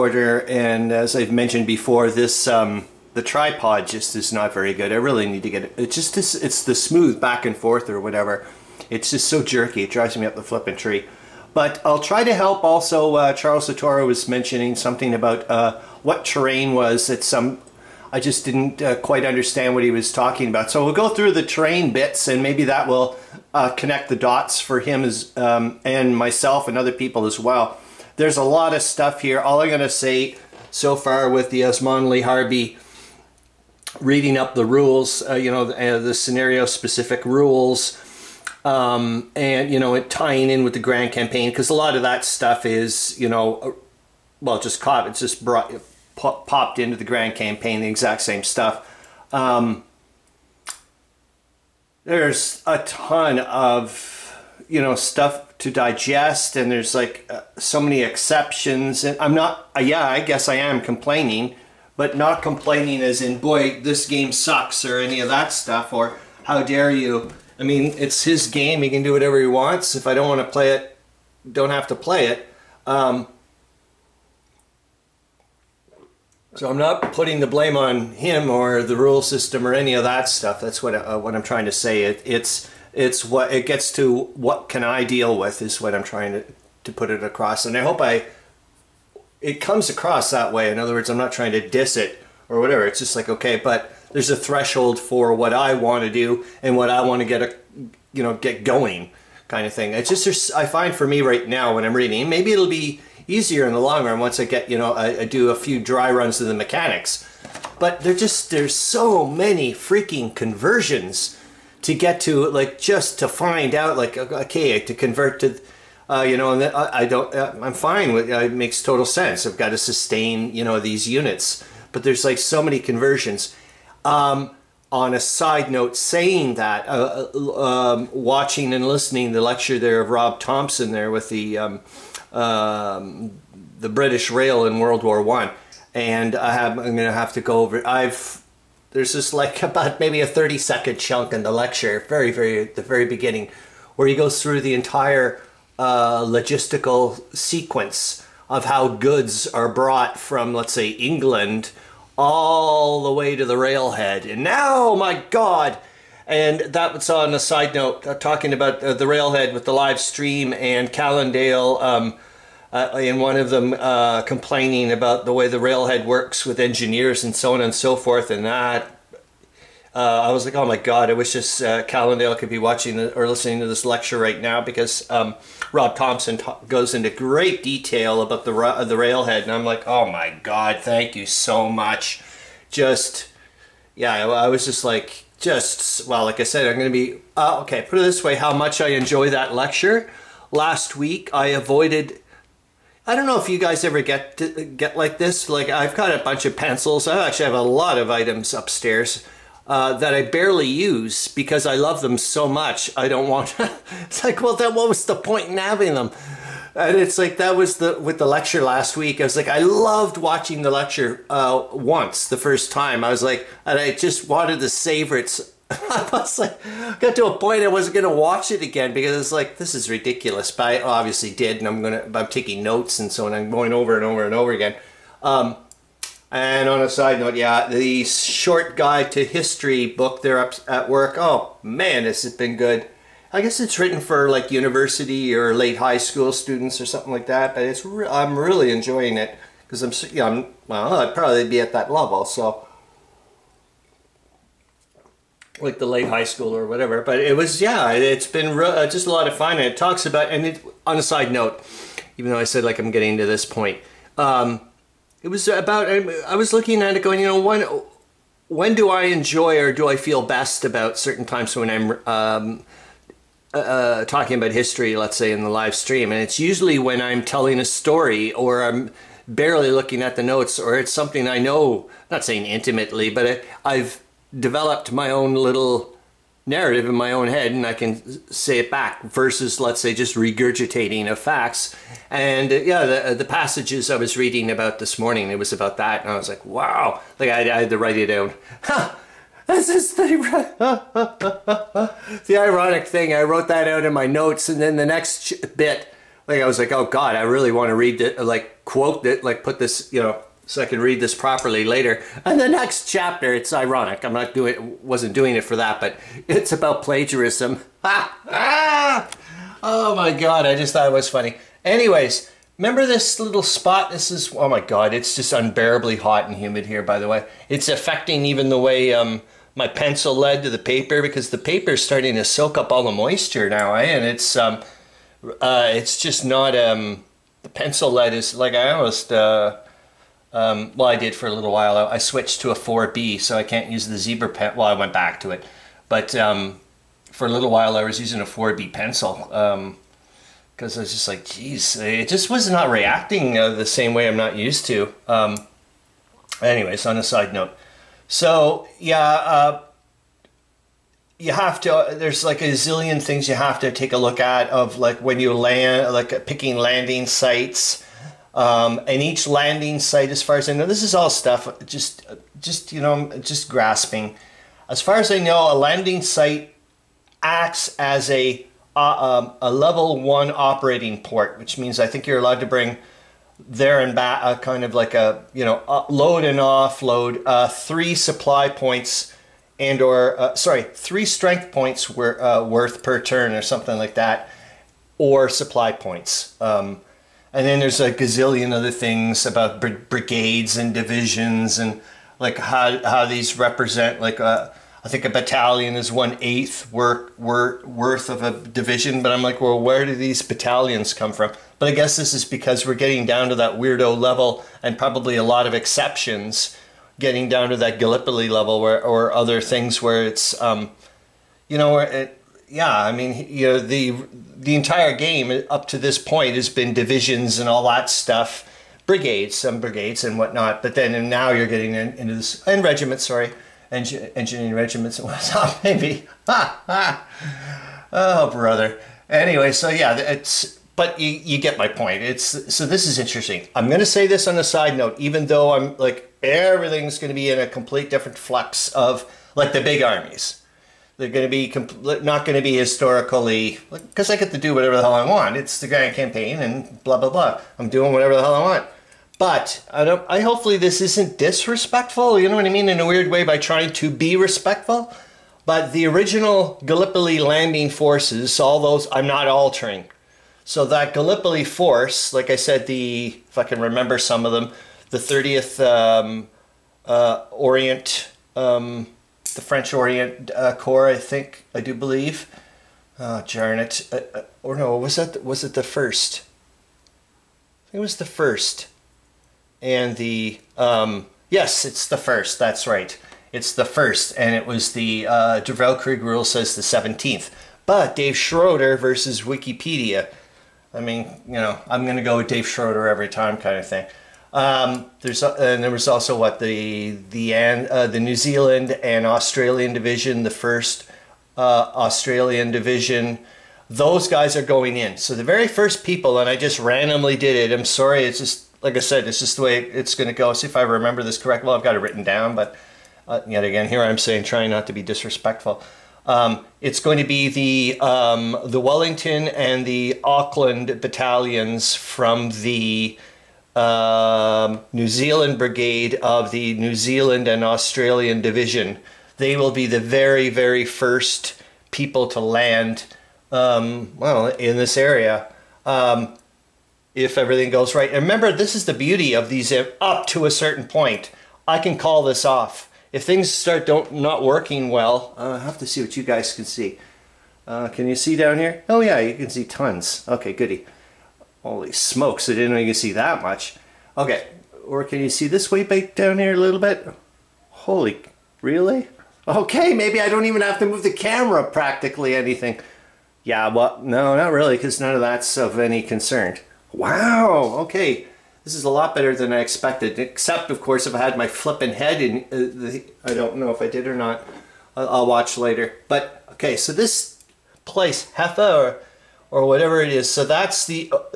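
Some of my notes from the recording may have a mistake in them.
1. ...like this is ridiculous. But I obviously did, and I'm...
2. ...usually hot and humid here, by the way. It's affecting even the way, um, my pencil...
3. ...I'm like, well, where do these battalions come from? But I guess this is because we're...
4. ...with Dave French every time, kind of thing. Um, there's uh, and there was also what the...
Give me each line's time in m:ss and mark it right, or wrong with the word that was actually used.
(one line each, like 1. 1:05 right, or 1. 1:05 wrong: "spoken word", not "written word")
1. 3:39 right
2. 5:15 wrong: "unbearably", not "usually"
3. 6:39 right
4. 8:12 wrong: "Schroeder", not "French".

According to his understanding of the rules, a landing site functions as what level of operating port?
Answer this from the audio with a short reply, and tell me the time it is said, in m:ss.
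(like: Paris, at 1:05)
Level one, at 6:09.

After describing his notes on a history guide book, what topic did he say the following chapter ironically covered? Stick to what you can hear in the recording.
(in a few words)
Plagiarism.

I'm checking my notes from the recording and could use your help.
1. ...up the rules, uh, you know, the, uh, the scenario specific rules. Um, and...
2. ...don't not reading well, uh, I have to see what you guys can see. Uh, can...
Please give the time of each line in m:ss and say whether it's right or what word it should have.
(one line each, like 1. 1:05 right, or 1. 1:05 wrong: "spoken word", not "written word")
1. 0:34 right
2. 9:03 wrong: "working", not "reading".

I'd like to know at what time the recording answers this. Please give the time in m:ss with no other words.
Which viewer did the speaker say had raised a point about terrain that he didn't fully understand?
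0:13.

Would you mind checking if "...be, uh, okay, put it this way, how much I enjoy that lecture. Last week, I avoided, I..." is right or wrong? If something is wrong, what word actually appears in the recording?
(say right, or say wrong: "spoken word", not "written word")
right.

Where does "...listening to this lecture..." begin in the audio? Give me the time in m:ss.
2:53.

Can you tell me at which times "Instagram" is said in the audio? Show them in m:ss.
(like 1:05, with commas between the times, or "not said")
not said.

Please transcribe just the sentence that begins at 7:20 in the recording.
They're going to be not going to be historically because like, I get to do whatever the hell I want.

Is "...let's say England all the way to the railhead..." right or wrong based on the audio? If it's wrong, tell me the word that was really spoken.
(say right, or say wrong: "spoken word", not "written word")
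right.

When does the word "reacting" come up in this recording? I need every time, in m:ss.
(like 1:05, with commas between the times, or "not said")
5:42.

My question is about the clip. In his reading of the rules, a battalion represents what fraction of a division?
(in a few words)
One eighth.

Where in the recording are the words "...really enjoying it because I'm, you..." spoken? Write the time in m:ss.
3:58.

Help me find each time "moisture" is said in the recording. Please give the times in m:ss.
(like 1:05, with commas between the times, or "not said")
5:22.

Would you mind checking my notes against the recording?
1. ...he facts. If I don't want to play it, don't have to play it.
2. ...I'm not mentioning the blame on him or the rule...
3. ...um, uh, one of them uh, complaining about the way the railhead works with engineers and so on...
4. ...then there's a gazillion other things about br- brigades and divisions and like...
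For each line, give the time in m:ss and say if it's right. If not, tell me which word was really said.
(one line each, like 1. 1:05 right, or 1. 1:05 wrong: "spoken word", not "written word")
1. 1:09 wrong: "wants", not "facts"
2. 1:16 wrong: "putting", not "mentioning"
3. 2:41 right
4. 6:27 right.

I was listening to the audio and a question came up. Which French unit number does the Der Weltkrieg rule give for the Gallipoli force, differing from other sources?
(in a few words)
17th.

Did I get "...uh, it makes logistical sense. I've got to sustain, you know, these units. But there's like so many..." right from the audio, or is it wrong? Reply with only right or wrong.
wrong.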